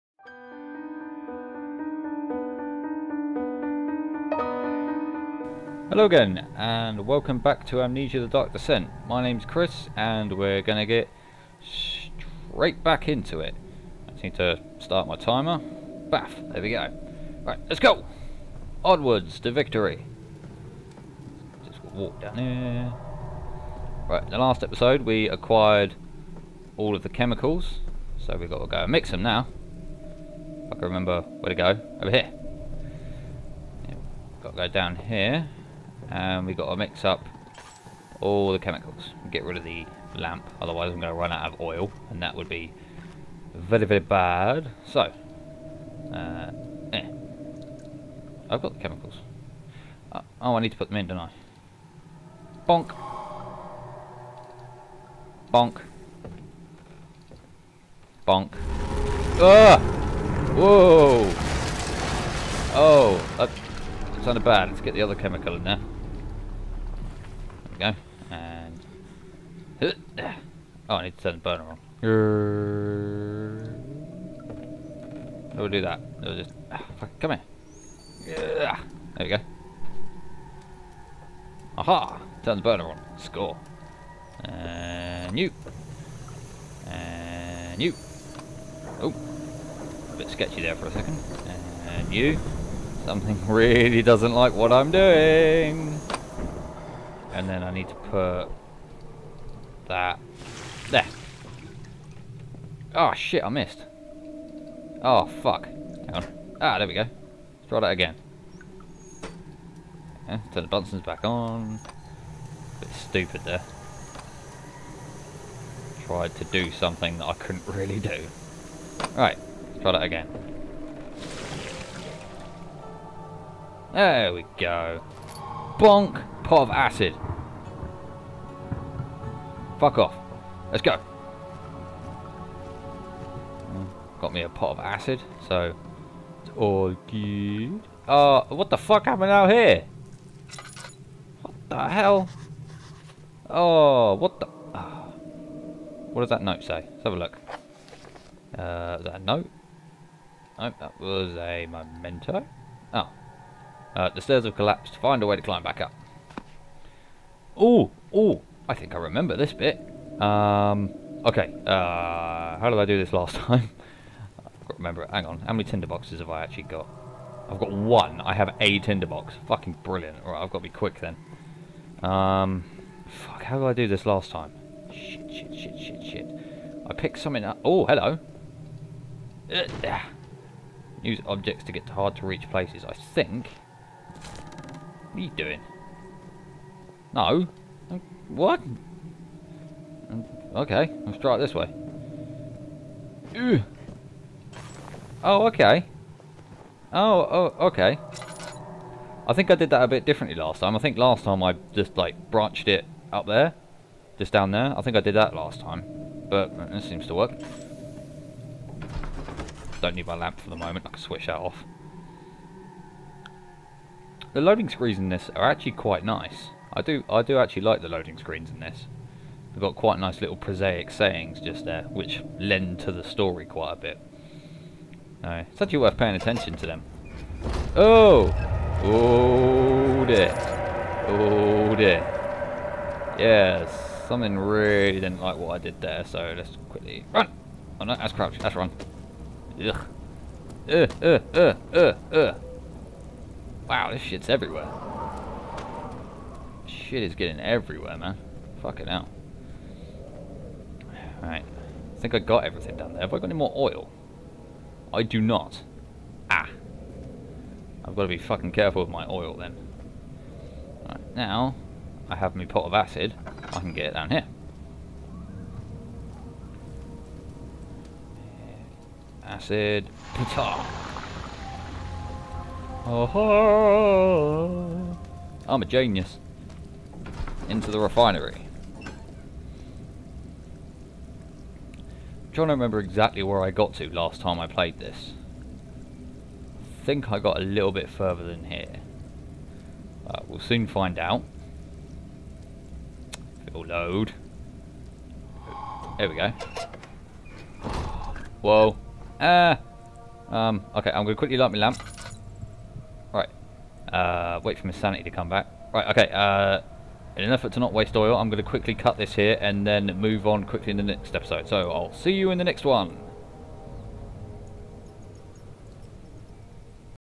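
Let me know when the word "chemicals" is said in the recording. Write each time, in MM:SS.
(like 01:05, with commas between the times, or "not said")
00:27, 00:38, 00:48, 01:05.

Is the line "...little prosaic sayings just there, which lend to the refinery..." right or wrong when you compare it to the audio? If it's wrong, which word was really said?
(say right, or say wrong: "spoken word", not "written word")
wrong: "story", not "refinery".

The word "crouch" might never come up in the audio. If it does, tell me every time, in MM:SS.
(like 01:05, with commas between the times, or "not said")
03:58.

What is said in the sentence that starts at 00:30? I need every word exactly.
If I can remember where to go.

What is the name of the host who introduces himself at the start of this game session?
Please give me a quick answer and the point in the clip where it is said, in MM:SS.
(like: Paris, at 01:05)
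Chris, at 00:09.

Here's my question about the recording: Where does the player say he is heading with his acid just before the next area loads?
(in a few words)
the refinery.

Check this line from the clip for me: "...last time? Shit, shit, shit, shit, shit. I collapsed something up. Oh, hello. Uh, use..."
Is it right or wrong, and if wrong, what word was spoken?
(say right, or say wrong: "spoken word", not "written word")
wrong: "picked", not "collapsed".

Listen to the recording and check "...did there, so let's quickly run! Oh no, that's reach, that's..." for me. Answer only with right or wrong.
wrong.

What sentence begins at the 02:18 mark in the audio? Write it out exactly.
Uh, what the fuck happened out here?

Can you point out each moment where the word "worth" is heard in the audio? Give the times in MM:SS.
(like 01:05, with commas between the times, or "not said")
03:45.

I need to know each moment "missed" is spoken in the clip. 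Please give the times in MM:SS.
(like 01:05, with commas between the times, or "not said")
01:43.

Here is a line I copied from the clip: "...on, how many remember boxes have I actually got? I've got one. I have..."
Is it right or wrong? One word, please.
wrong.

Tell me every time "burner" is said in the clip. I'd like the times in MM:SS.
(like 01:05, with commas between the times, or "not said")
01:11, 01:22.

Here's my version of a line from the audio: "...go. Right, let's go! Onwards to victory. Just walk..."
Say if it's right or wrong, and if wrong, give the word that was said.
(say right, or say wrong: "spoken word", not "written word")
right.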